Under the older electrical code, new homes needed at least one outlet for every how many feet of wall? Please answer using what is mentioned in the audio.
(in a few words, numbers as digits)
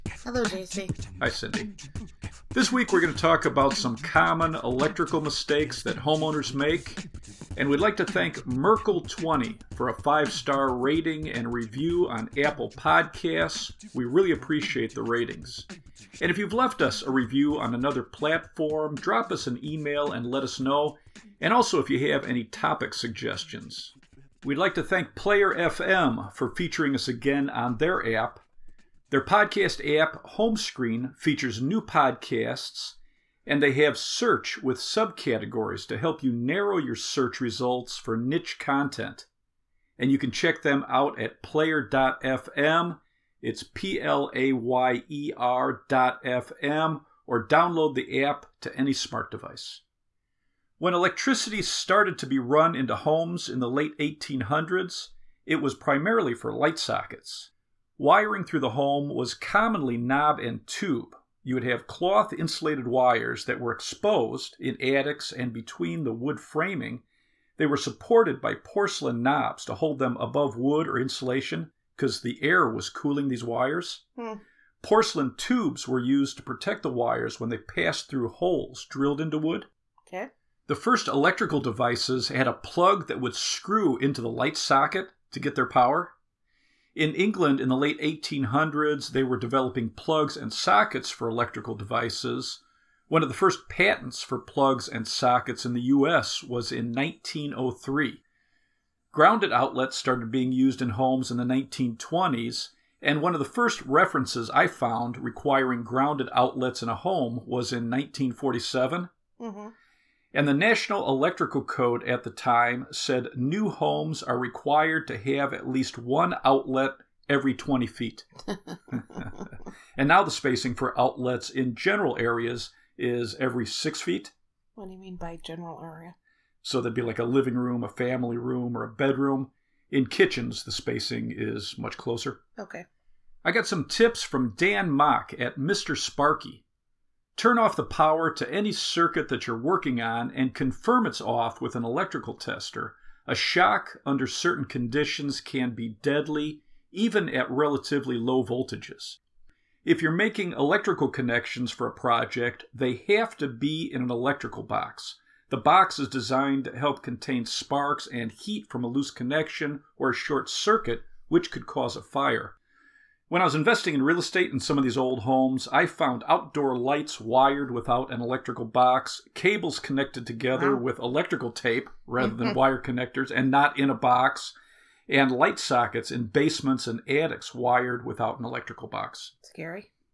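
20 feet.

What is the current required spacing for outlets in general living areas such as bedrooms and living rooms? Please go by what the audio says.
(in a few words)
Every 6 feet.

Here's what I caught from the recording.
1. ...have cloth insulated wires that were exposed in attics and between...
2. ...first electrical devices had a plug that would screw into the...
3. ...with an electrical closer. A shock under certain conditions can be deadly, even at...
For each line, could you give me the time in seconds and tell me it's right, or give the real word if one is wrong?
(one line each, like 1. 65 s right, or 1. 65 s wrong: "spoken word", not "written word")
1. 61 s right
2. 80 s right
3. 141 s wrong: "tester", not "closer".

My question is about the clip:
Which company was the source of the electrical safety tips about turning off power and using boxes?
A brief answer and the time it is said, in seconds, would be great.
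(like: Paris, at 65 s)
Mr. Sparky, at 135 s.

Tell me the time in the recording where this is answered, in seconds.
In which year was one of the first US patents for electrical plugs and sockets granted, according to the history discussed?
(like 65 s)
96 s.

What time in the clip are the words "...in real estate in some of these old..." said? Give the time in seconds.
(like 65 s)
163 s.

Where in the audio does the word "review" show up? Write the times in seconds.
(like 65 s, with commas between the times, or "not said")
11 s, 17 s.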